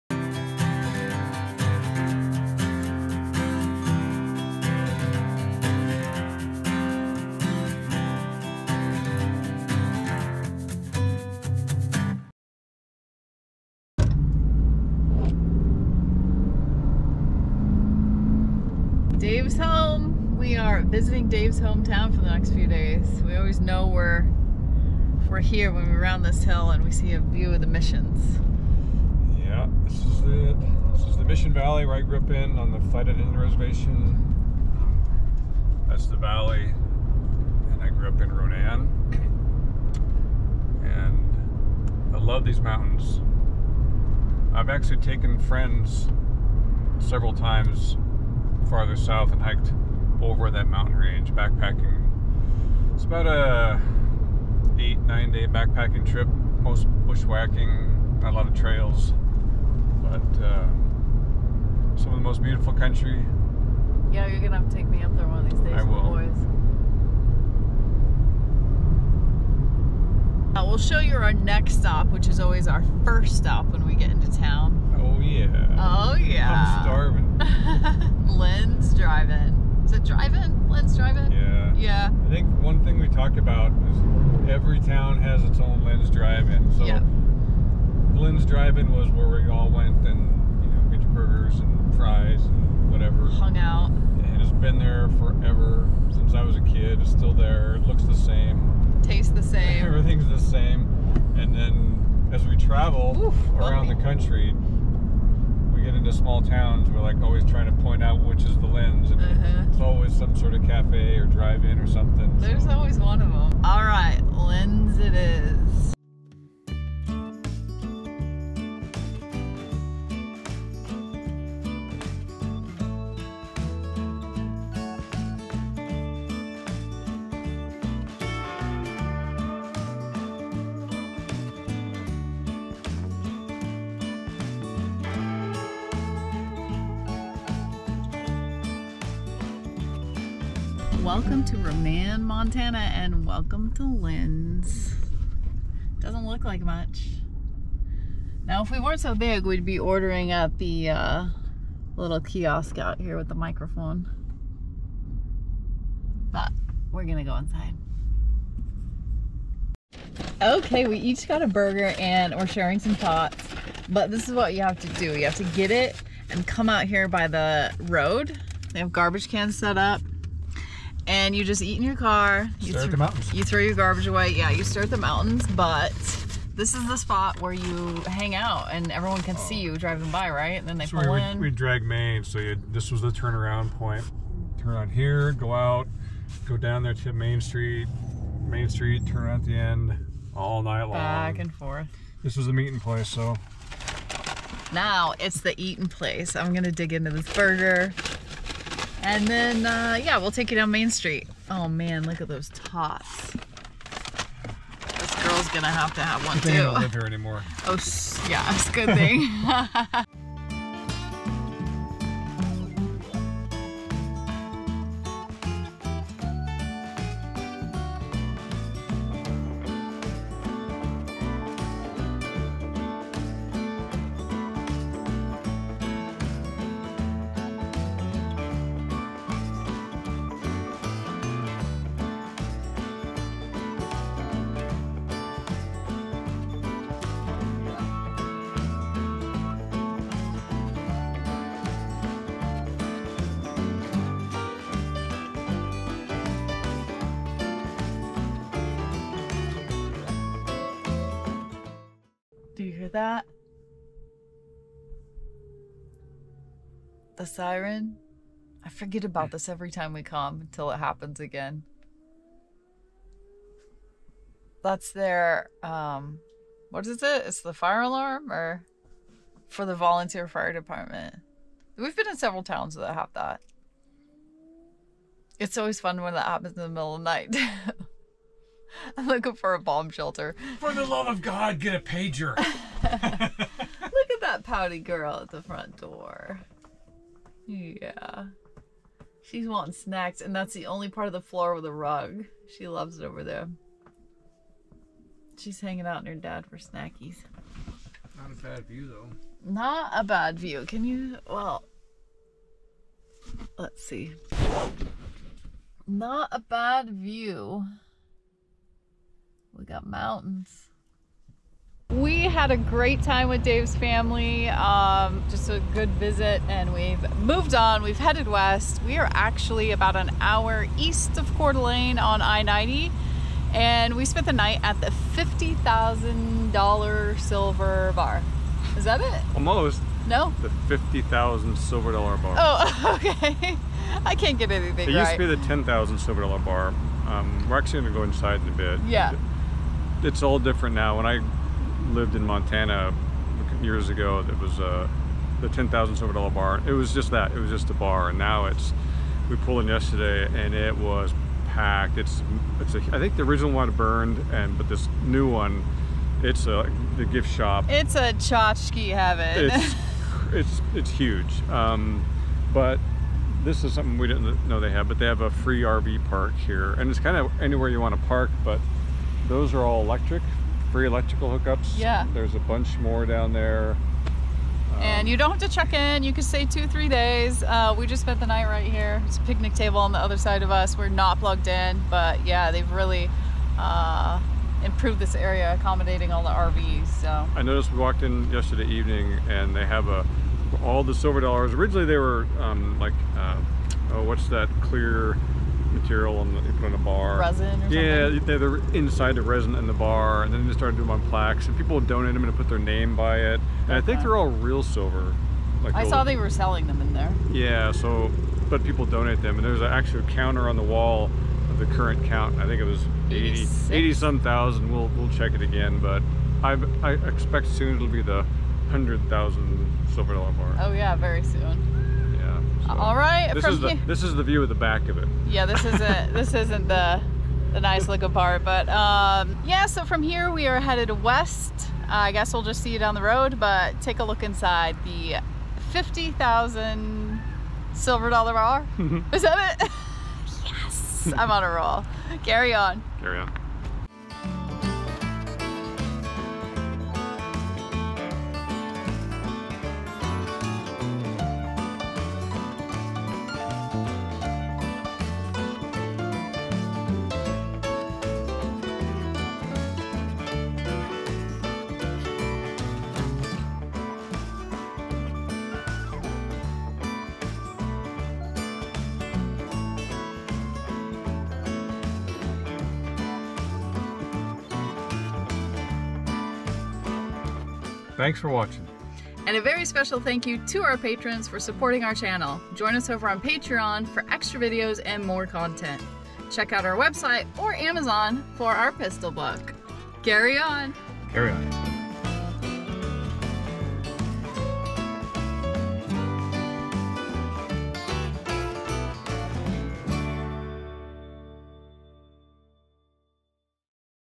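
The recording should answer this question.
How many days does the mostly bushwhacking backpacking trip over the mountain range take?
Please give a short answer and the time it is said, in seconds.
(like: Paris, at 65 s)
8 or 9 days, at 54 s.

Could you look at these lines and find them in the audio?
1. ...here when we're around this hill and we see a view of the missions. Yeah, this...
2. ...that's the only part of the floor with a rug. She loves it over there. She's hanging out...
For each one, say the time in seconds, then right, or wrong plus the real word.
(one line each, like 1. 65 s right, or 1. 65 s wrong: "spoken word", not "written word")
1. 25 s right
2. 290 s right.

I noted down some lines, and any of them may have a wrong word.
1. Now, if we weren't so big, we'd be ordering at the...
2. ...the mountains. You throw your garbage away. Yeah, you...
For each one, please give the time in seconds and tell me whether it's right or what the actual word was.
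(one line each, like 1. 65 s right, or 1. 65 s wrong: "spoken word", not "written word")
1. 148 s right
2. 172 s right.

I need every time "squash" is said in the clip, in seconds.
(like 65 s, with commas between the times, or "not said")
not said.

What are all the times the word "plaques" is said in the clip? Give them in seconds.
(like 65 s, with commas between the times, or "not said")
401 s.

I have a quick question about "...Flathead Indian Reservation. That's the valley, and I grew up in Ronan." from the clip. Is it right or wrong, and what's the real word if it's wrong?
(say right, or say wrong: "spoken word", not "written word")
right.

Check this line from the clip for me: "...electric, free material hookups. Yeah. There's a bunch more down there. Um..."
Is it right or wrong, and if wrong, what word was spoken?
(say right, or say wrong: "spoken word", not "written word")
wrong: "electrical", not "material".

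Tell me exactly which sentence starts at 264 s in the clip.
That's their um what is it?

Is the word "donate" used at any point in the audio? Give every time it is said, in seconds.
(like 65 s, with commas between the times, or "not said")
401 s, 408 s.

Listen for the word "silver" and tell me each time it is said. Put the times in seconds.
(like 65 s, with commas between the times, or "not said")
327 s, 331 s, 335 s, 345 s, 390 s, 404 s, 419 s, 437 s.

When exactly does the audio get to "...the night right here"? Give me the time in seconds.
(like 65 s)
378 s.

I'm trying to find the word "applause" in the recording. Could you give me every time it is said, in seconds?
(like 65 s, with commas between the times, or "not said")
not said.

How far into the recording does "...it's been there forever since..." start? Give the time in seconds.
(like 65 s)
94 s.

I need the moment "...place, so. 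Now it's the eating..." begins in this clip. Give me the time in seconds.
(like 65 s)
192 s.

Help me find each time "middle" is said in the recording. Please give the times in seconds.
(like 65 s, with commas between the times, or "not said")
276 s.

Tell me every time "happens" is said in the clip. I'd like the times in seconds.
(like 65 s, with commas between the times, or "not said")
260 s, 276 s.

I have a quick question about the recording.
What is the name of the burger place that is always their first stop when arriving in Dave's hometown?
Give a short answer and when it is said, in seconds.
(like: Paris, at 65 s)
Lynn's Drive-In, at 85 s.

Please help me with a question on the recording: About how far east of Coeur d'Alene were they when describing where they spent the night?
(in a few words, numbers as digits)
1 hour.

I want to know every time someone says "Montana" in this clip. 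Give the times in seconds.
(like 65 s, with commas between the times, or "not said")
142 s, 342 s.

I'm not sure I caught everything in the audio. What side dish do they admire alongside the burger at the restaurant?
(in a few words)
Tots.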